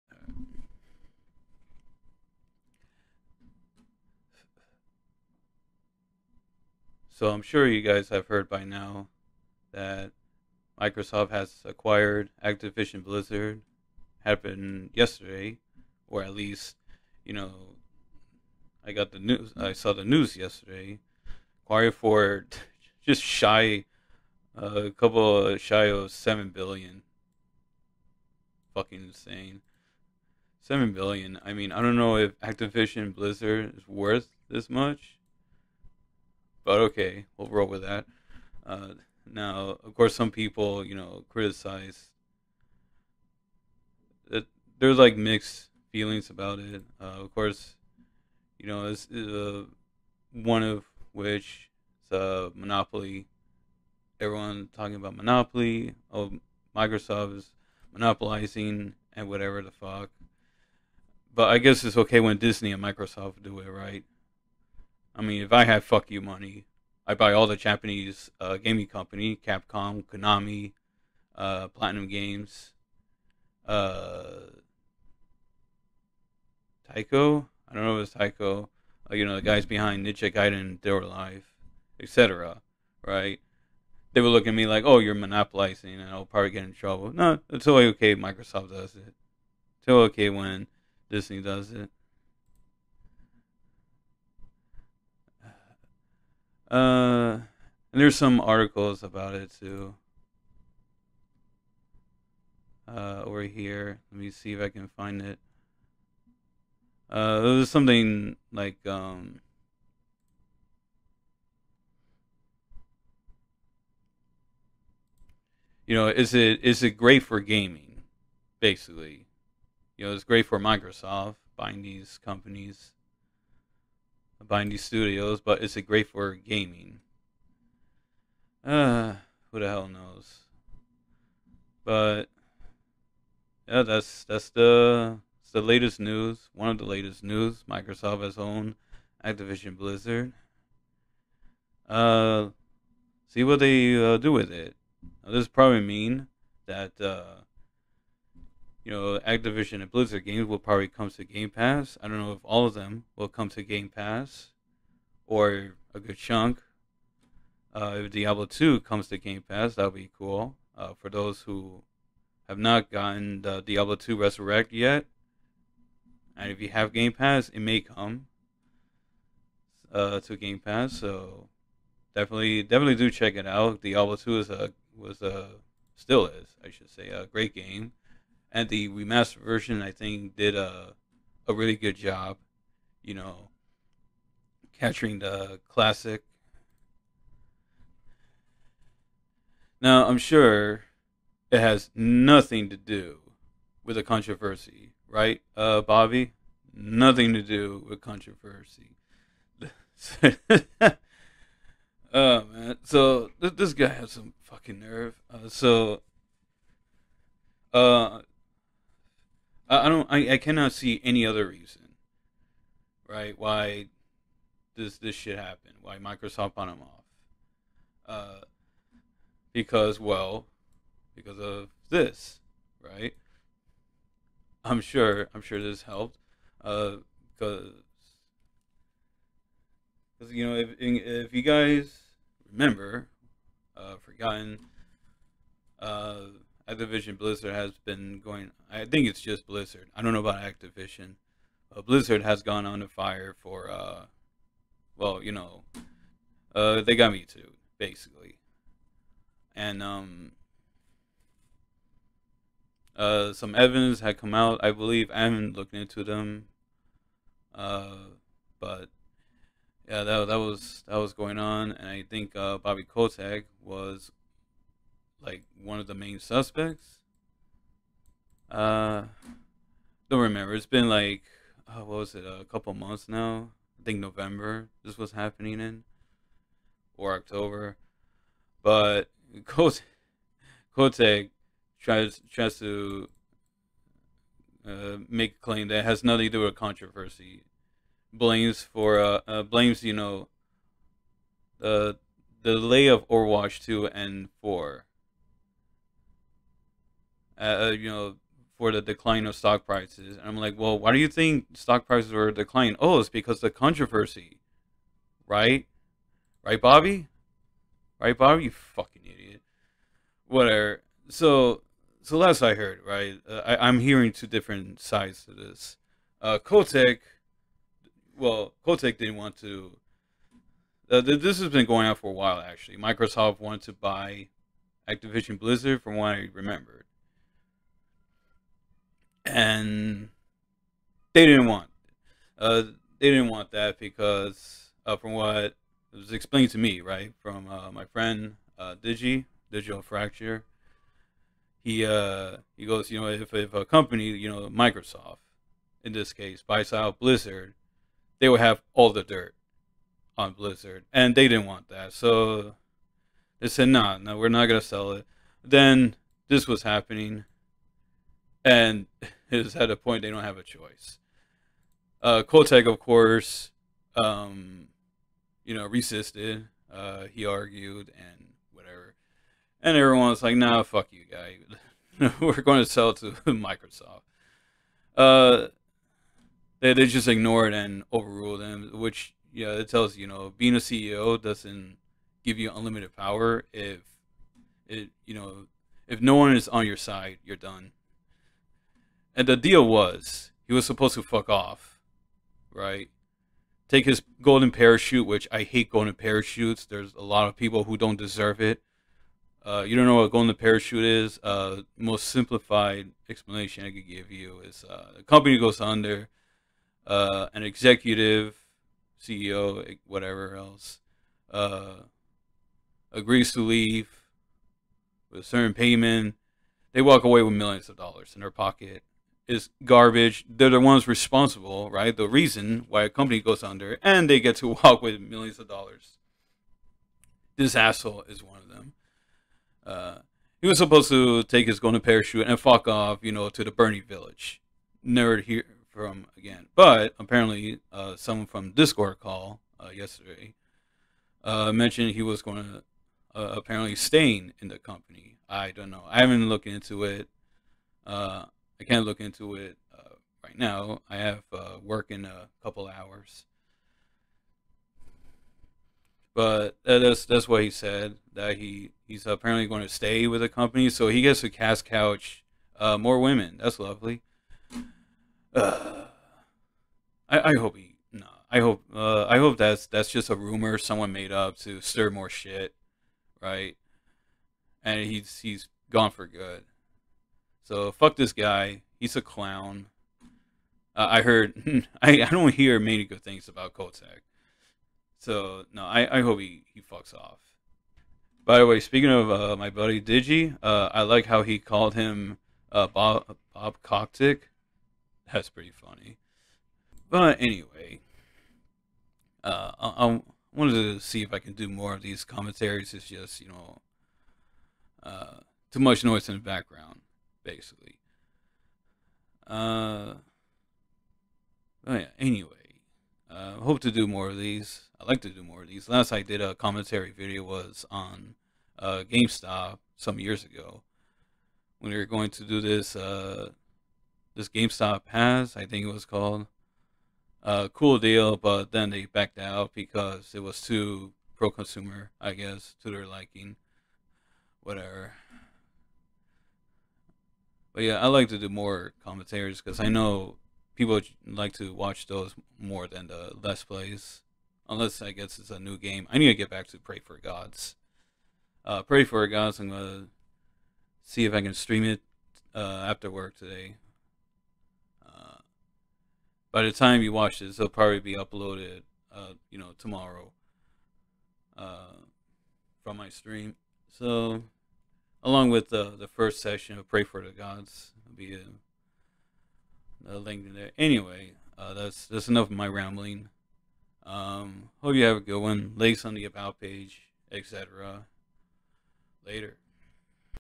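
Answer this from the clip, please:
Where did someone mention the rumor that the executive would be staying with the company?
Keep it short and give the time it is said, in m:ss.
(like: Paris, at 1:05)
Discord, at 7:18.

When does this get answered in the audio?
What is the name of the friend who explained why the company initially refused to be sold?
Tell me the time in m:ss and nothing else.
5:39.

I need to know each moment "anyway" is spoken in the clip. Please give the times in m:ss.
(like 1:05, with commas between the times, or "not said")
8:17, 8:31, 9:30.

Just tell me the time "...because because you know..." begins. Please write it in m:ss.
3:47.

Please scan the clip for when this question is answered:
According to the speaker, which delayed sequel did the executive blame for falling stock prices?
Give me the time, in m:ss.
4:53.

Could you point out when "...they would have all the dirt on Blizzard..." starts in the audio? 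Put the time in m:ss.
5:48.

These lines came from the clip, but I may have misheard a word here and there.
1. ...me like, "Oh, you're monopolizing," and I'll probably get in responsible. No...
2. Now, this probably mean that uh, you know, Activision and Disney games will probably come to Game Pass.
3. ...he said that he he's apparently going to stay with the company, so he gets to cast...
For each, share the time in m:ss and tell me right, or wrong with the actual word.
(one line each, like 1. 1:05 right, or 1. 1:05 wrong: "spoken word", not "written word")
1. 1:24 wrong: "trouble", not "responsible"
2. 2:25 wrong: "Blizzard", not "Disney"
3. 7:37 right.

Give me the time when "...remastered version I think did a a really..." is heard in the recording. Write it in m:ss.
2:58.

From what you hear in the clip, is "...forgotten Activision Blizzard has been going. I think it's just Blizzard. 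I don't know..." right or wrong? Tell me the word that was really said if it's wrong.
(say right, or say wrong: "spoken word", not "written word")
right.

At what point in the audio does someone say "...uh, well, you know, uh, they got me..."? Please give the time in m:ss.
4:03.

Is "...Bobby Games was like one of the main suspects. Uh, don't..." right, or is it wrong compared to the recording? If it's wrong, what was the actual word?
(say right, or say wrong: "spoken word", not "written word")
wrong: "Kotick", not "Games".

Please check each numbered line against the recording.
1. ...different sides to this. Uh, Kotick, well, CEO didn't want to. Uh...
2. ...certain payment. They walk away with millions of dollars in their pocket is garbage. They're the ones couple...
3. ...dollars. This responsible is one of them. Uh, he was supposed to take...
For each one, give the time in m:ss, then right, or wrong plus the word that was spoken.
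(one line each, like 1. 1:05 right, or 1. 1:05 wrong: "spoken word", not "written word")
1. 5:14 wrong: "Kotick", not "CEO"
2. 6:55 wrong: "responsible", not "couple"
3. 7:05 wrong: "asshole", not "responsible".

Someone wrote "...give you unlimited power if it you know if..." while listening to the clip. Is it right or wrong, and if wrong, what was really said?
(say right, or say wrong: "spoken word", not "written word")
right.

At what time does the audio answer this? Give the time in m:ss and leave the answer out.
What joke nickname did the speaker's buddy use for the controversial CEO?
8:13.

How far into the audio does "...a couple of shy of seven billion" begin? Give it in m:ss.
0:24.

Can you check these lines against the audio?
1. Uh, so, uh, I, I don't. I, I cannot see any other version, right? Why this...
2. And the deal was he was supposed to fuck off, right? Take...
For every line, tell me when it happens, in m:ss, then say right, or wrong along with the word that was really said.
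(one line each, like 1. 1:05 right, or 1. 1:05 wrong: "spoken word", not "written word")
1. 3:25 wrong: "reason", not "version"
2. 6:29 right.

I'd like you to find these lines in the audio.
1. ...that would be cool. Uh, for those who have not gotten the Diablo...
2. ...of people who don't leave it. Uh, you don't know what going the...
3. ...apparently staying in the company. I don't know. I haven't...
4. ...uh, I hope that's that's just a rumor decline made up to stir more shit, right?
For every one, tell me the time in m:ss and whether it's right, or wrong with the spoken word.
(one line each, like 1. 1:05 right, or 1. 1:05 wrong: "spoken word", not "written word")
1. 2:39 right
2. 6:37 wrong: "deserve", not "leave"
3. 7:23 right
4. 7:48 wrong: "someone", not "decline".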